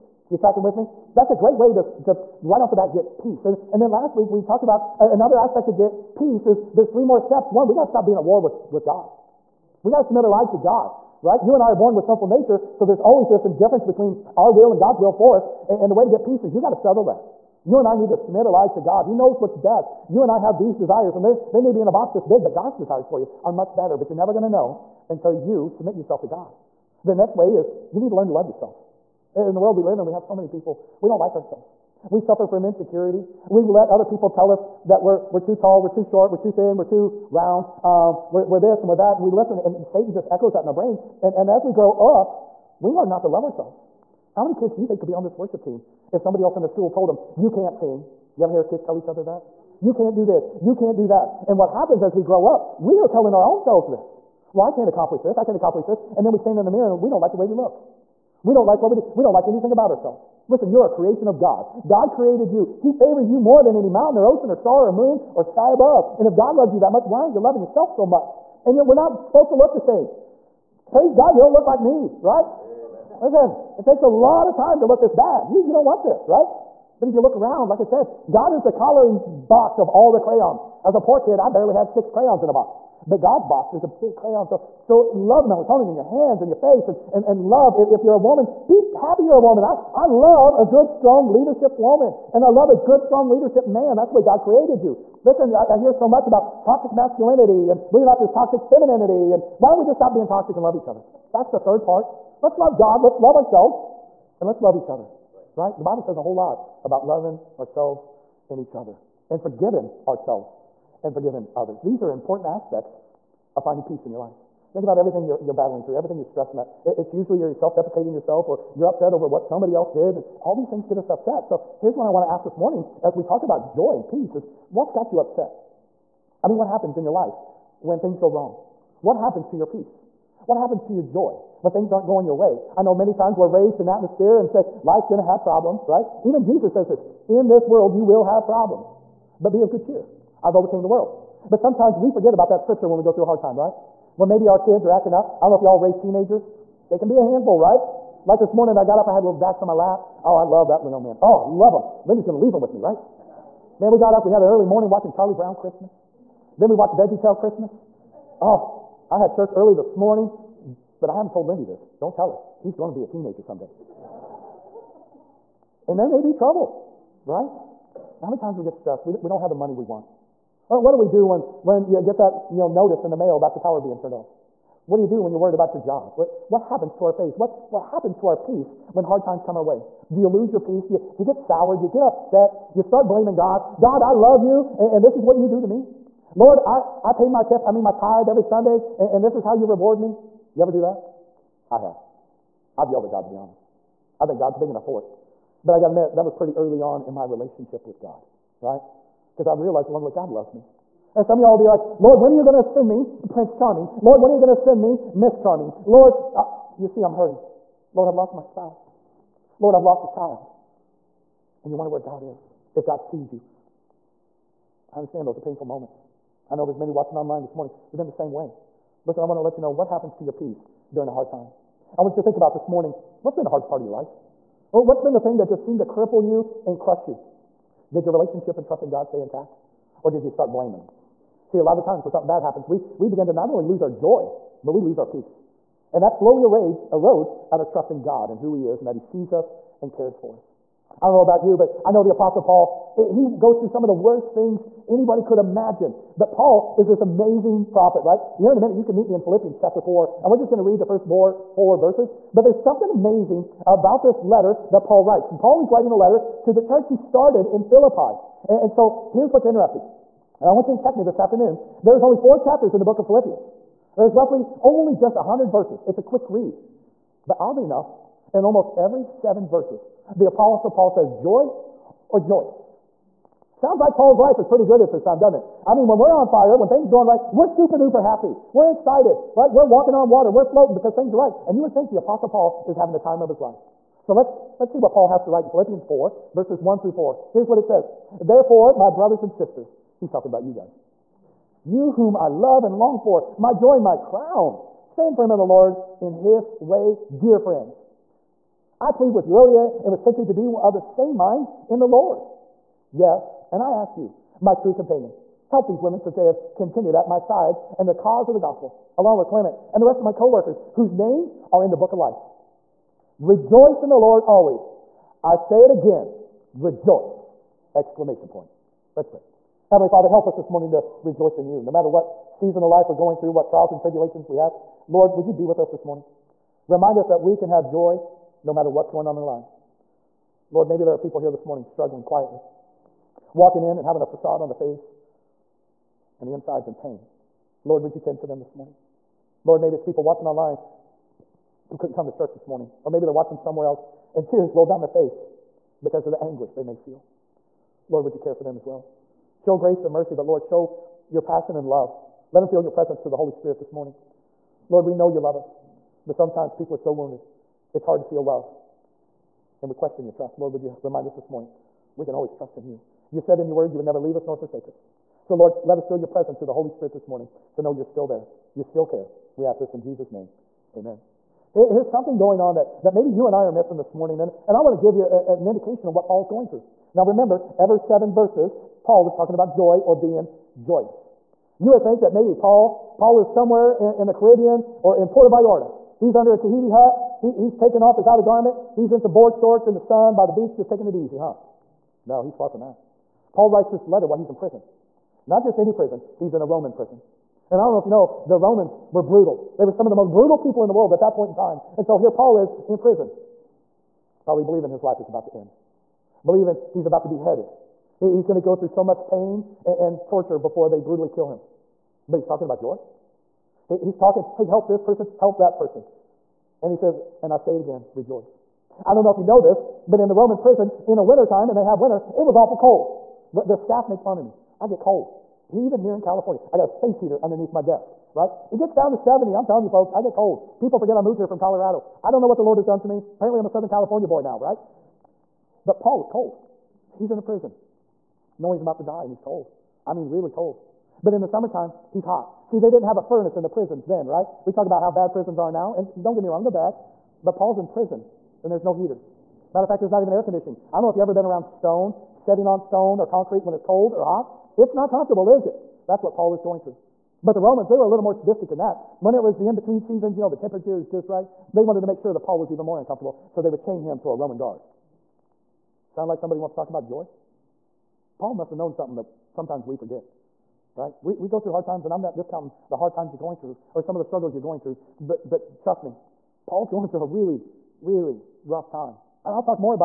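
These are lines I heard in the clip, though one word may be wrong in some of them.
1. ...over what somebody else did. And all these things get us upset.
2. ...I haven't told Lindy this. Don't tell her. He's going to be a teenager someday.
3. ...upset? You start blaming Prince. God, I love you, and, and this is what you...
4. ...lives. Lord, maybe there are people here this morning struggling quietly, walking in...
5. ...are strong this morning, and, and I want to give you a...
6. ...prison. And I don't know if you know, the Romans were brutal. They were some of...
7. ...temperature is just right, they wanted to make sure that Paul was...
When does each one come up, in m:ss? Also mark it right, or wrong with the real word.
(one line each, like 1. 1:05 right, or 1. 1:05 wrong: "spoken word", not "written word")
1. 1:59 right
2. 2:41 right
3. 3:02 wrong: "God", not "Prince"
4. 5:29 right
5. 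6:13 wrong: "missing", not "strong"
6. 6:36 right
7. 7:40 right.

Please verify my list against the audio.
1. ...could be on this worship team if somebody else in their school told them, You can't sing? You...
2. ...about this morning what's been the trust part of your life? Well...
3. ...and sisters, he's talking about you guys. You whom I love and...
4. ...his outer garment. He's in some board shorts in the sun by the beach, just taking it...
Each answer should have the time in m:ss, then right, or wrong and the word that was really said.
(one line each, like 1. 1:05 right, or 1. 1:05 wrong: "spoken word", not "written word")
1. 0:44 right
2. 3:42 wrong: "hardest", not "trust"
3. 4:49 right
4. 6:27 right.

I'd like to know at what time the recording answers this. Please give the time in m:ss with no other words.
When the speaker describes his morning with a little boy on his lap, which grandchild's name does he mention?
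2:29.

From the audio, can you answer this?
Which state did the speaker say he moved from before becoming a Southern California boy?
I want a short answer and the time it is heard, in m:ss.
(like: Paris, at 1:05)
Colorado, at 7:11.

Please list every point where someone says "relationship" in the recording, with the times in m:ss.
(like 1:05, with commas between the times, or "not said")
3:17, 3:48.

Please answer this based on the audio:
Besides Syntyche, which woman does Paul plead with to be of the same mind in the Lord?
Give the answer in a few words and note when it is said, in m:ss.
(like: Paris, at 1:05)
Erodia, at 4:59.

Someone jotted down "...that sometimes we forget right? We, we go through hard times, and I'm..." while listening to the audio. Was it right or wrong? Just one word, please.
right.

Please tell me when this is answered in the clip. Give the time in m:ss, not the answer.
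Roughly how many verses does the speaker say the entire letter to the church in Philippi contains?
4:25.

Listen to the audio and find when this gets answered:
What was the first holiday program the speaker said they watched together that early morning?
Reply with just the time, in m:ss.
2:35.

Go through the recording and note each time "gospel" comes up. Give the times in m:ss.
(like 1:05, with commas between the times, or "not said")
5:08.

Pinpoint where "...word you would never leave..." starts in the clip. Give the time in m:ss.
6:03.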